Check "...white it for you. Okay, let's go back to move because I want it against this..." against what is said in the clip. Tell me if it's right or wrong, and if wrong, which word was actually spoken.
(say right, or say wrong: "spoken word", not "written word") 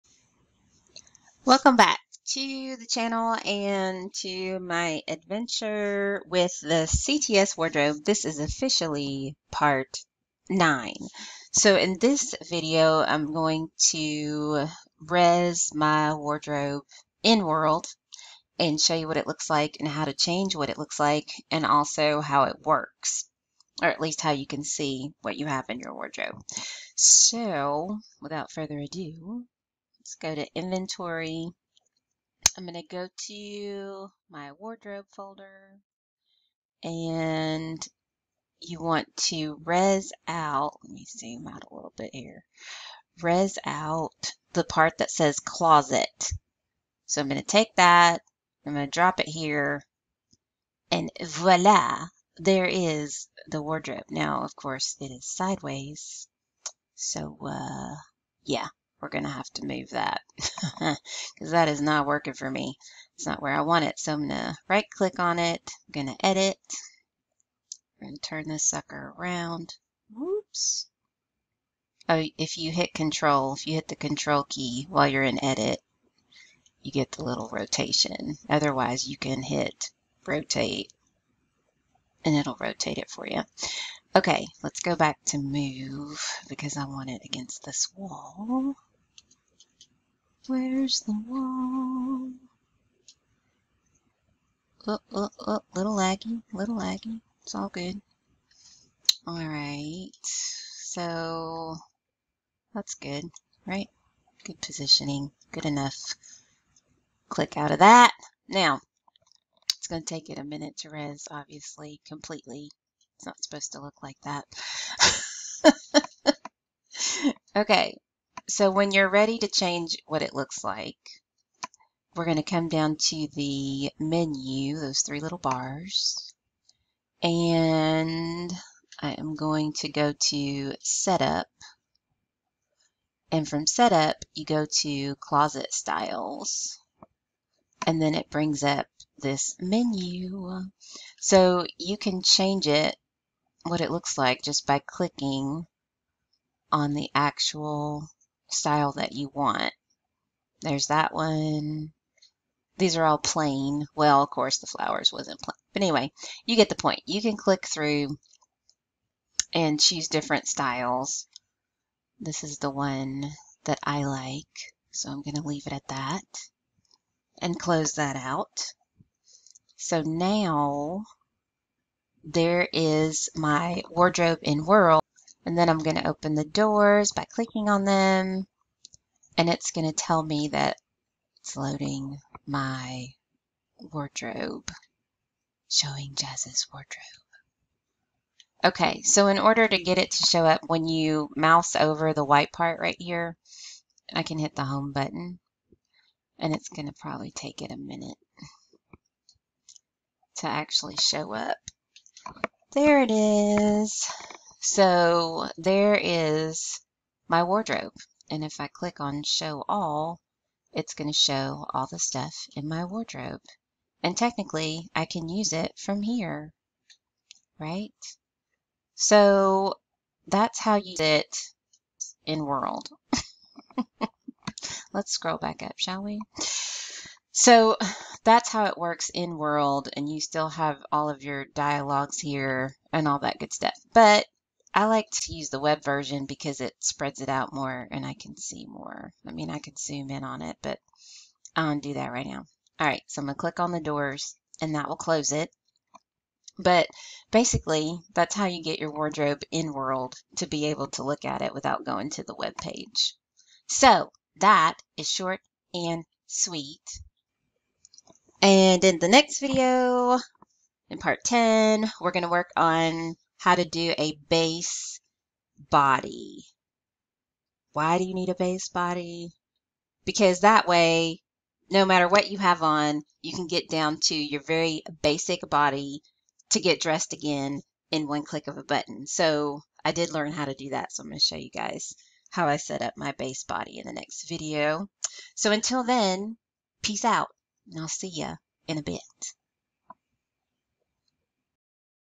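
wrong: "rotate", not "white".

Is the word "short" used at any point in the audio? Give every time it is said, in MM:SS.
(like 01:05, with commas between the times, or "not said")
04:15.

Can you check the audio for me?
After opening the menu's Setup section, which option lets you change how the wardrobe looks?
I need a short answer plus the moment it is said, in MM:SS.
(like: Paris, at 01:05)
Closet Styles, at 02:15.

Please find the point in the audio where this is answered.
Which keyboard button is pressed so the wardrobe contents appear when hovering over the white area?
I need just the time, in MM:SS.
03:14.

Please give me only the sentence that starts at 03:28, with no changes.
And if I click on show all, it's going to show all the stuff in my wardrobe.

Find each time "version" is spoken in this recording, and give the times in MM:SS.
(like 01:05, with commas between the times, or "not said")
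03:55.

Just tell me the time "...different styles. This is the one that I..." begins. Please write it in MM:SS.
02:40.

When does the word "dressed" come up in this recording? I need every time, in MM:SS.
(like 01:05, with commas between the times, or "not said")
04:36.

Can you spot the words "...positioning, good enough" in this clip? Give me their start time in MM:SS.
01:44.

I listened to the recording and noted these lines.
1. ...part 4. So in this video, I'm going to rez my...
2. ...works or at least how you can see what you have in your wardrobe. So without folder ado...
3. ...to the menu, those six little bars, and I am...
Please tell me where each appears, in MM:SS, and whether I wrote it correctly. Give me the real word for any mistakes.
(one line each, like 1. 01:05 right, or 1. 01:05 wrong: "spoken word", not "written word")
1. 00:09 wrong: "9", not "4"
2. 00:22 wrong: "further", not "folder"
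3. 02:02 wrong: "three", not "six".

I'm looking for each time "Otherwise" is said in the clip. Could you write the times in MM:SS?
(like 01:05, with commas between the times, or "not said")
01:18.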